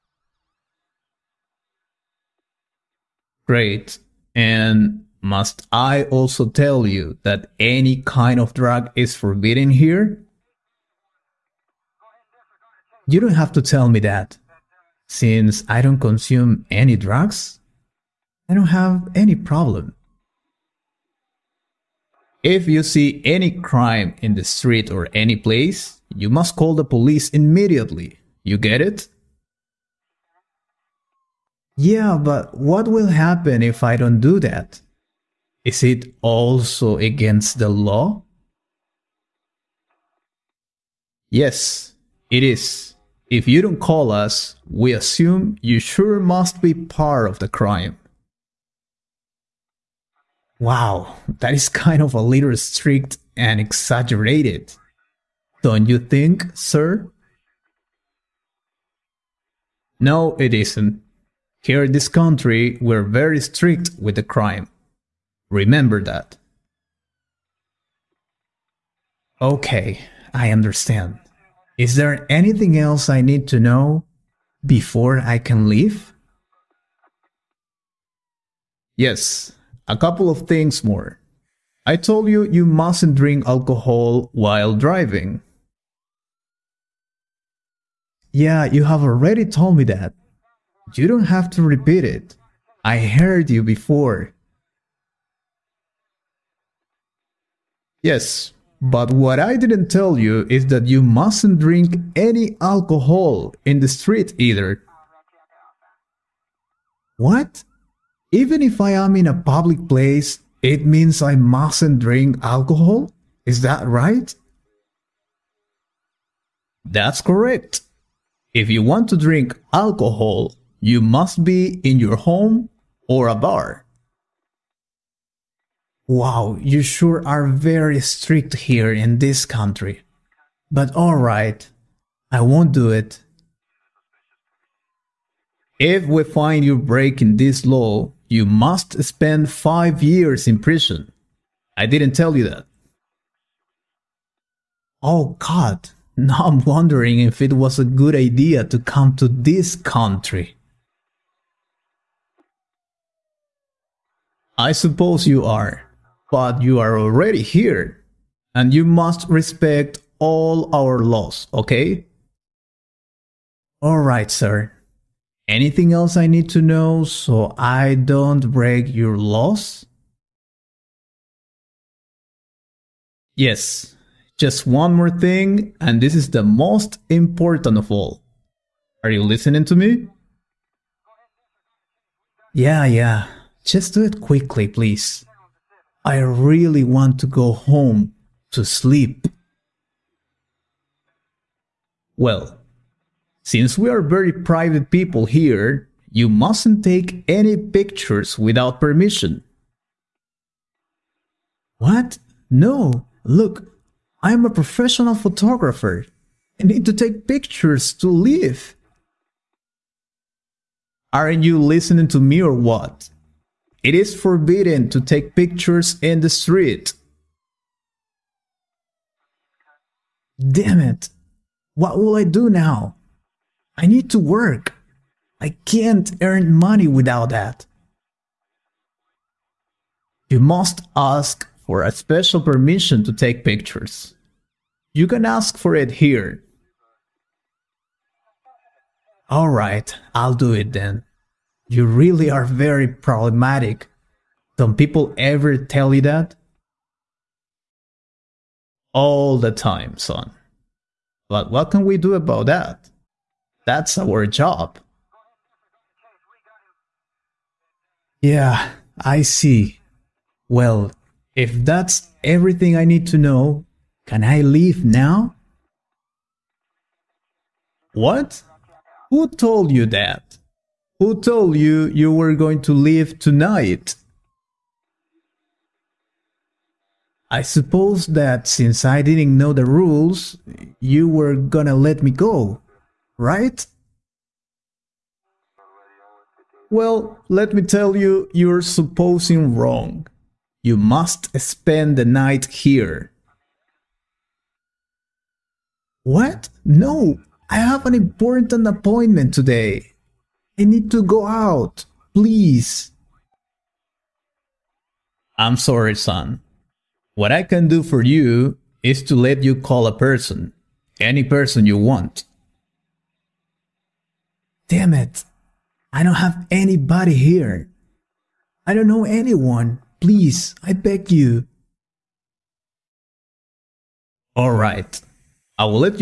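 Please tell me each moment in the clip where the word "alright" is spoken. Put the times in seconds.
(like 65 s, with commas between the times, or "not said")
130 s, 163 s, 239 s.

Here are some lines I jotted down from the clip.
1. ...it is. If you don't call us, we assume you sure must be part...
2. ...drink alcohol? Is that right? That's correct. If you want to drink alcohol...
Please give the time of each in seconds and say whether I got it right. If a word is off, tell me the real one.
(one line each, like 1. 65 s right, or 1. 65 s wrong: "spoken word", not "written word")
1. 42 s right
2. 111 s right.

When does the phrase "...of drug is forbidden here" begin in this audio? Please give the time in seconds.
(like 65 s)
8 s.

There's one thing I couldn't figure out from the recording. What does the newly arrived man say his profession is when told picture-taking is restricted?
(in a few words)
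professional photographer.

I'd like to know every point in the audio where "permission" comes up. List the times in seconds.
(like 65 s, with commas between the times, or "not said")
198 s, 232 s.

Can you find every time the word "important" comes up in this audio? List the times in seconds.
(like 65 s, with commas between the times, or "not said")
177 s, 297 s.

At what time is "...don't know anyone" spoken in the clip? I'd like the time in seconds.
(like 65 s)
318 s.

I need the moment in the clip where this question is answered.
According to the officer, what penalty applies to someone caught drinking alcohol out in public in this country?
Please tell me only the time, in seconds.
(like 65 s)
139 s.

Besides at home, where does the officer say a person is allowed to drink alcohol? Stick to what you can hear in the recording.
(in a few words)
a bar.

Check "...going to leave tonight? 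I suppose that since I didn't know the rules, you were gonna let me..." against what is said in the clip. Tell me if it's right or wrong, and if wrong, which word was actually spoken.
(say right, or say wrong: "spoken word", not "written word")
right.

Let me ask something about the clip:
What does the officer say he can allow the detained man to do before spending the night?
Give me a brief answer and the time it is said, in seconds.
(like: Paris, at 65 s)
call a person, at 309 s.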